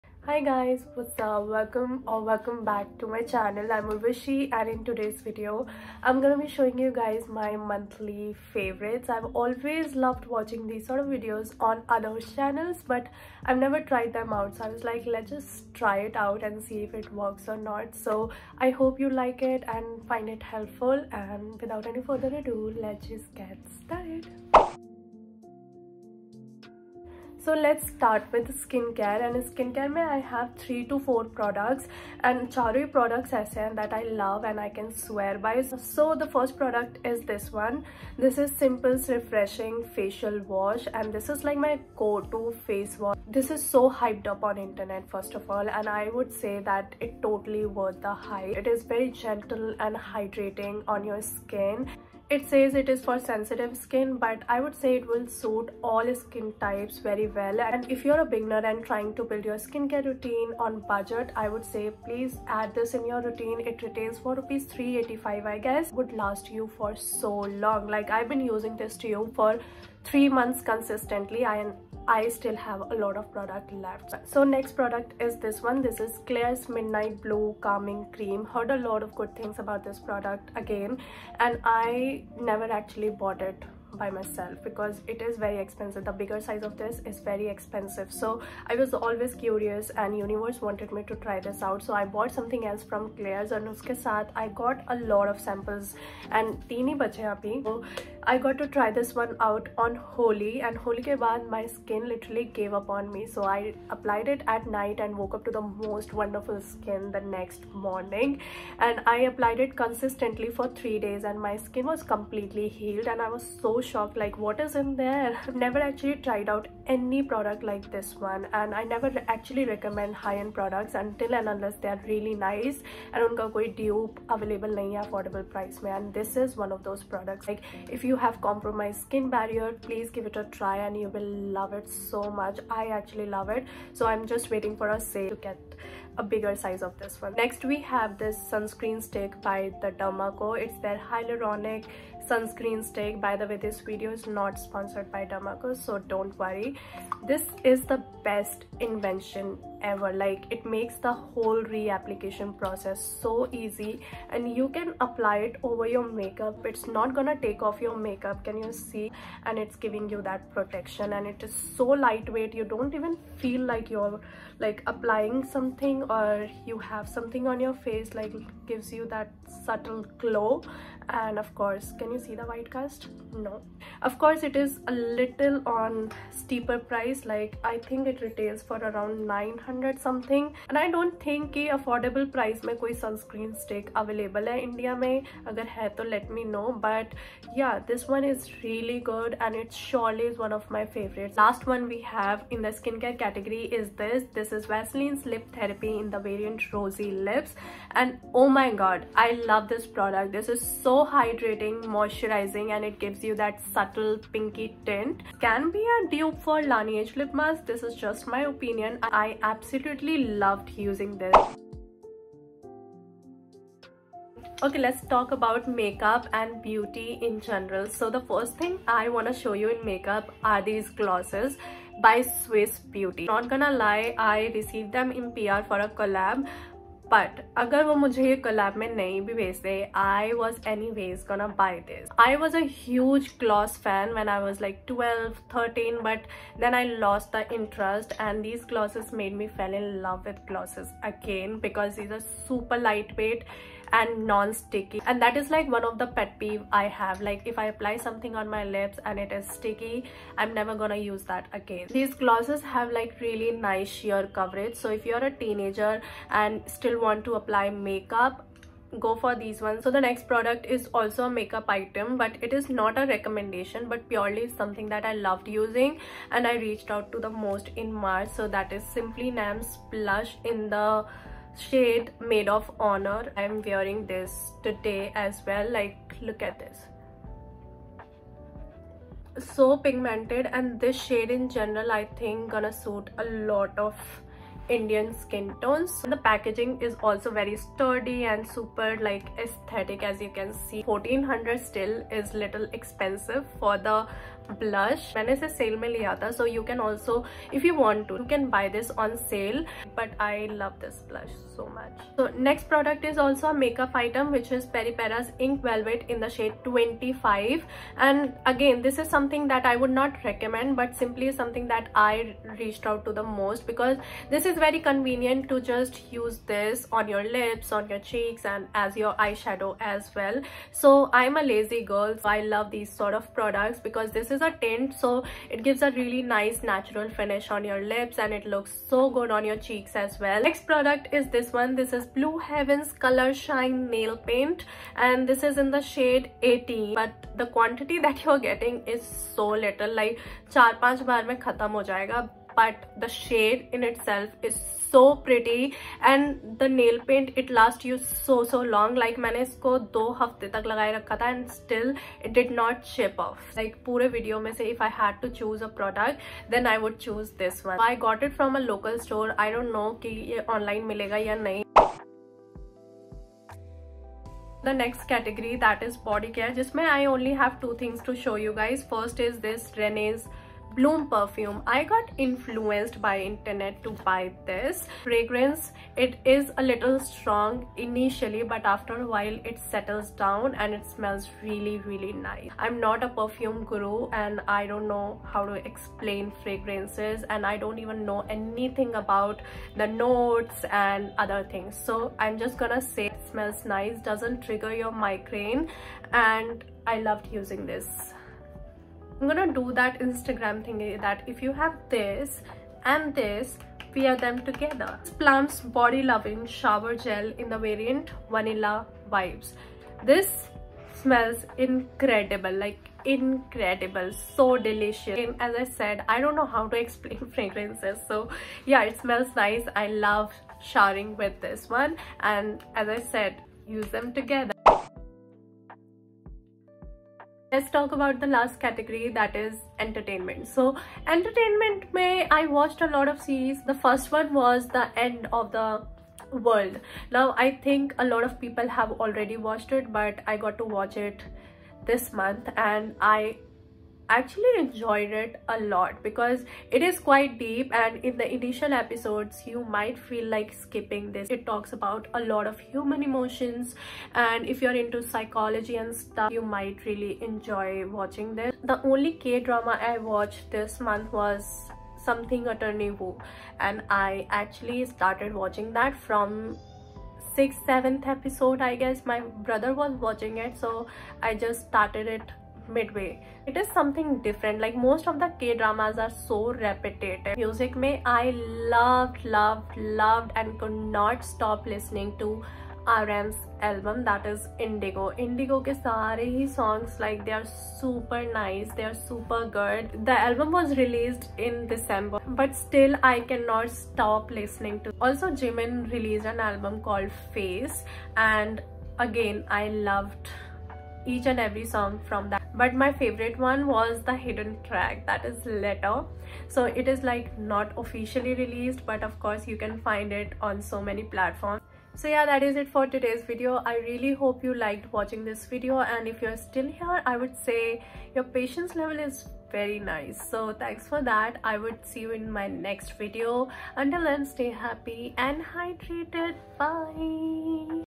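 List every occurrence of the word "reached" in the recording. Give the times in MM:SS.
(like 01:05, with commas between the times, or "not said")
04:26, 05:12.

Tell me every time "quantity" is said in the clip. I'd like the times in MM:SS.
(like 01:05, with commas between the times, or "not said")
05:37.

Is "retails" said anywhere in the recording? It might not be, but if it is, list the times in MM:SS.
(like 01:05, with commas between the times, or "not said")
01:03, 02:58.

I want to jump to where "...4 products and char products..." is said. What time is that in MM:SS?
00:31.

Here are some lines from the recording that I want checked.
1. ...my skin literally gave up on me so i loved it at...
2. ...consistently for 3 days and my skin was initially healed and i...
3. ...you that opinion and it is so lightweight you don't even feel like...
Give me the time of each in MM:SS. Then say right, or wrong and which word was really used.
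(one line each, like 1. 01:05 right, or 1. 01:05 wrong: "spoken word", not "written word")
1. 01:41 wrong: "applied", not "loved"
2. 01:49 wrong: "completely", not "initially"
3. 02:40 wrong: "protection", not "opinion".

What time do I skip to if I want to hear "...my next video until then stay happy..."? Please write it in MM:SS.
08:42.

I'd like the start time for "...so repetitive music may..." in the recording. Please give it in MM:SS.
07:56.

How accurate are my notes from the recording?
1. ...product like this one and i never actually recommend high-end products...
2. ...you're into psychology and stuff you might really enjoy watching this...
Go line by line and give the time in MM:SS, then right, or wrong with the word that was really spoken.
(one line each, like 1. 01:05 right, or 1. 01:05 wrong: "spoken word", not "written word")
1. 01:57 right
2. 07:34 right.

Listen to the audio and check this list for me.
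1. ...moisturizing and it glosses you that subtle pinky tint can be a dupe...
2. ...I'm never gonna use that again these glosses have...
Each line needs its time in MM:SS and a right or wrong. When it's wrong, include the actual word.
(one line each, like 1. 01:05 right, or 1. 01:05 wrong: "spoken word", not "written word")
1. 03:21 wrong: "gives", not "glosses"
2. 04:10 right.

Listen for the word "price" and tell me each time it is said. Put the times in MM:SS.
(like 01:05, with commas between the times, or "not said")
02:05, 02:56.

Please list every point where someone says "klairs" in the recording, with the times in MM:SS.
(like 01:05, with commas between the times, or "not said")
01:16, 01:33.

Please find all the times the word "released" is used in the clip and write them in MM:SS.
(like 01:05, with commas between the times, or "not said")
08:10, 08:15, 08:28.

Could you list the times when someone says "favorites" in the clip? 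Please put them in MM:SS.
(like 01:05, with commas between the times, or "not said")
00:08, 08:22.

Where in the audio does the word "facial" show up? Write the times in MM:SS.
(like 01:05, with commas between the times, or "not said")
00:39.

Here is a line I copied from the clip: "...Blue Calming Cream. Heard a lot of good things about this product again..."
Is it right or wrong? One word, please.
right.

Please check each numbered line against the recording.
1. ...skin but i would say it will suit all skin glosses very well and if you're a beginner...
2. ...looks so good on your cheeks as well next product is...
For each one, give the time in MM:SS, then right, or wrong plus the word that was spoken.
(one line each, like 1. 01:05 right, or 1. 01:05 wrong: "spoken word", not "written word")
1. 00:53 wrong: "types", not "glosses"
2. 05:28 right.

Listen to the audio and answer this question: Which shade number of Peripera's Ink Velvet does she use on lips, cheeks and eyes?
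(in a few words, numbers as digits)
25.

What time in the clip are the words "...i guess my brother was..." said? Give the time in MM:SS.
07:48.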